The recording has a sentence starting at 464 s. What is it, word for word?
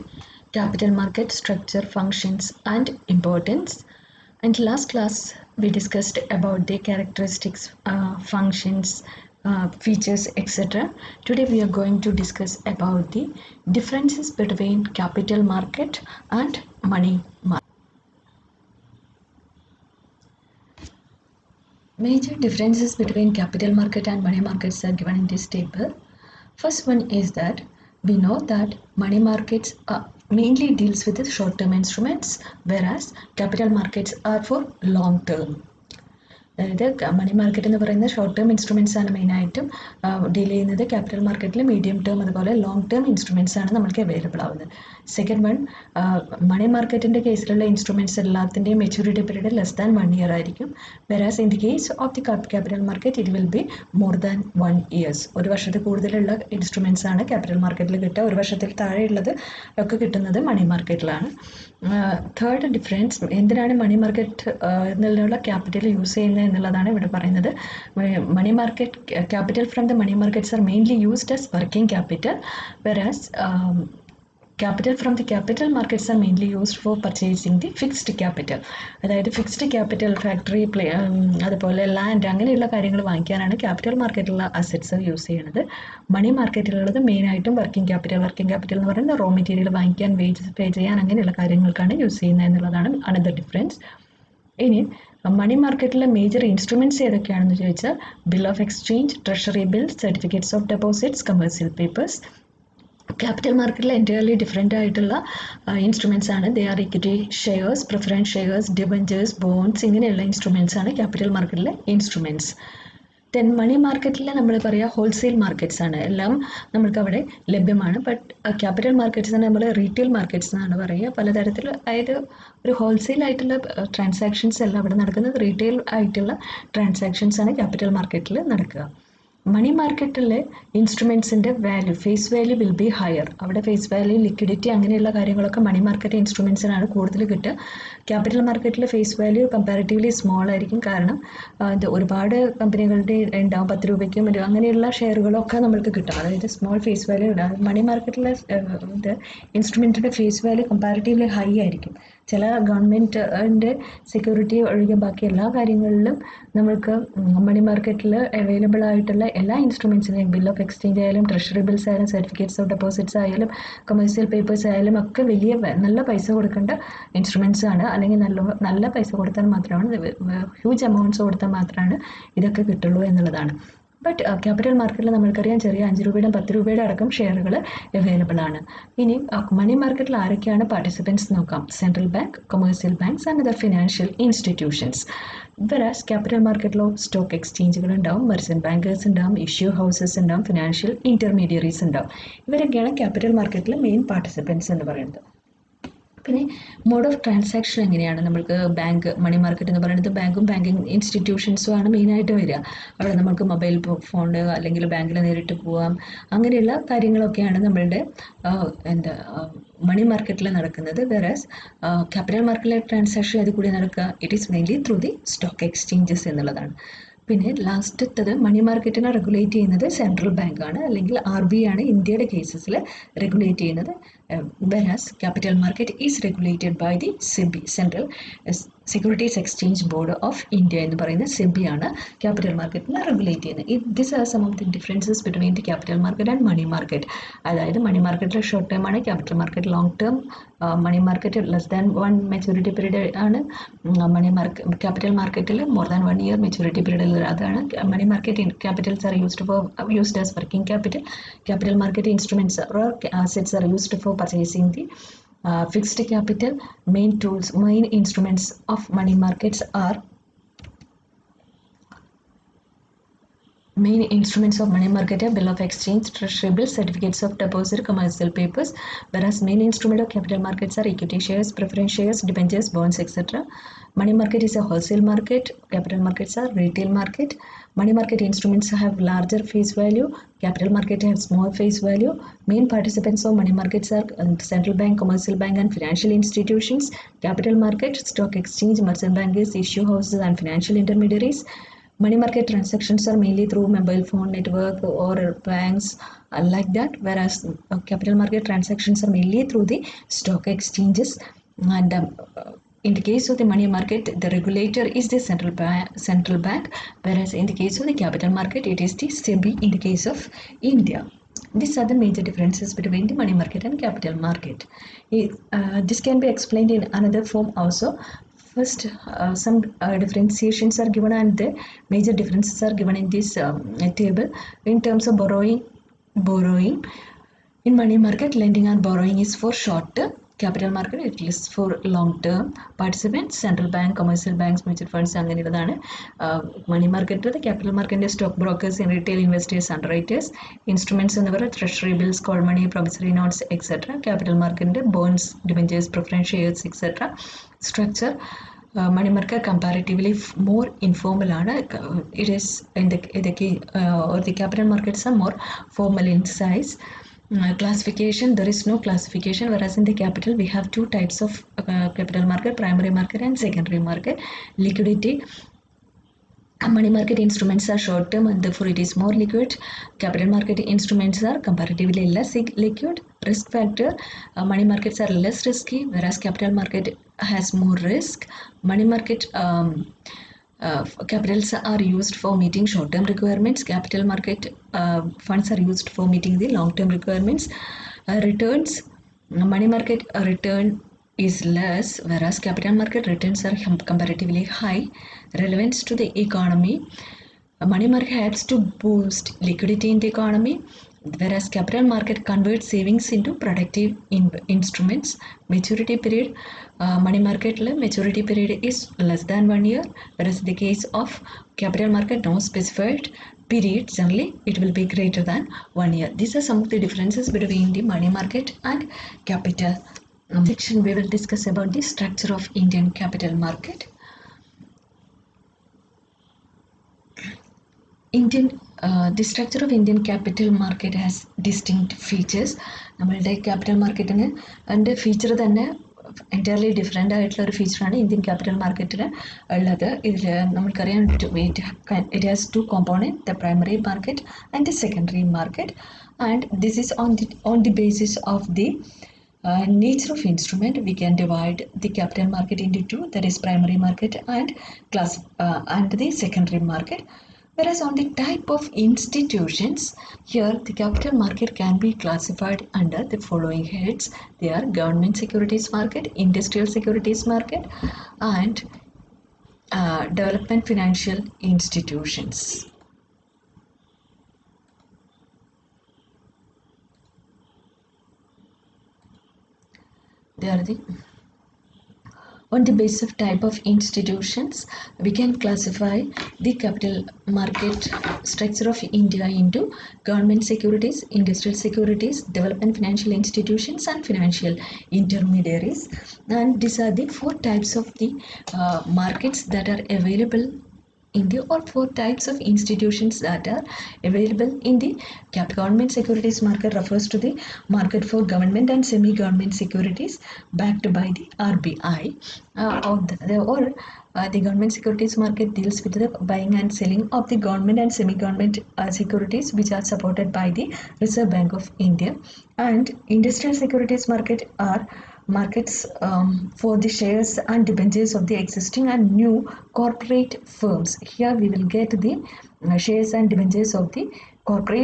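They are government securities market, industrial securities market and uh, development financial institutions.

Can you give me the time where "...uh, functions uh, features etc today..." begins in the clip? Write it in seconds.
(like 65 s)
7 s.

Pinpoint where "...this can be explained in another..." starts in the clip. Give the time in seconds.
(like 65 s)
315 s.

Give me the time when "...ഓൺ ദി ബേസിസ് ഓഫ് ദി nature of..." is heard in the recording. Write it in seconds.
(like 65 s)
447 s.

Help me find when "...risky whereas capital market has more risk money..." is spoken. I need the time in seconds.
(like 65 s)
375 s.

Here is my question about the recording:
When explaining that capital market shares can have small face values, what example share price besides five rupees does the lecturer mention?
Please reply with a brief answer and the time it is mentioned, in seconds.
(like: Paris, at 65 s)
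10 rupees, at 143 s.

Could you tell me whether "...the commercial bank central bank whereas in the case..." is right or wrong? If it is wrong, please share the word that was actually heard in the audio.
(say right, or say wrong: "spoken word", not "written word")
wrong: "central", not "commercial".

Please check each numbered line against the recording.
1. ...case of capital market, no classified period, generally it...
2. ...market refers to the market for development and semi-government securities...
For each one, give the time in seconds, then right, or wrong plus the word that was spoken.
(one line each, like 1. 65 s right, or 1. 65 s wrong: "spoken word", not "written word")
1. 410 s wrong: "specified", not "classified"
2. 506 s wrong: "government", not "development".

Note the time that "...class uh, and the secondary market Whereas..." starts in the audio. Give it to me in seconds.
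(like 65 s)
454 s.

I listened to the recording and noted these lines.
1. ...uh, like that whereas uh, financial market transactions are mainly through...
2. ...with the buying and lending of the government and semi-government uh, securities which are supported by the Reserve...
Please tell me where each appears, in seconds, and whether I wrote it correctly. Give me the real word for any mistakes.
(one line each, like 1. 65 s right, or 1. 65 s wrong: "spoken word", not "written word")
1. 296 s wrong: "capital", not "financial"
2. 515 s wrong: "selling", not "lending".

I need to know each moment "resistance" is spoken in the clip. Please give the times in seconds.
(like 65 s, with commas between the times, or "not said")
not said.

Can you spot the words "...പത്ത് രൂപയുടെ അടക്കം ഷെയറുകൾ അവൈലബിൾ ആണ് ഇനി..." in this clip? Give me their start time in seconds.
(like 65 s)
176 s.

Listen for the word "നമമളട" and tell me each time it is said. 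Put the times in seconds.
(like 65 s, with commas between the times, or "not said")
207 s, 432 s.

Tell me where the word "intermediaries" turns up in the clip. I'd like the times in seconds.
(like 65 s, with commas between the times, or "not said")
290 s, 494 s.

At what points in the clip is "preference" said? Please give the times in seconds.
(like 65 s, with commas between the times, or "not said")
271 s.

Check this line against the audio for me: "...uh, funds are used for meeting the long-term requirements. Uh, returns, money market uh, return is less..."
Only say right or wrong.
right.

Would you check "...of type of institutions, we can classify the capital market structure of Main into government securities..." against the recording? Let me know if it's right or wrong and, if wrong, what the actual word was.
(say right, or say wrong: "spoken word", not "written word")
wrong: "India", not "Main".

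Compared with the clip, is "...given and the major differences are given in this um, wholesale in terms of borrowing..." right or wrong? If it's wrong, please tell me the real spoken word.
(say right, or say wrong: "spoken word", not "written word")
wrong: "table", not "wholesale".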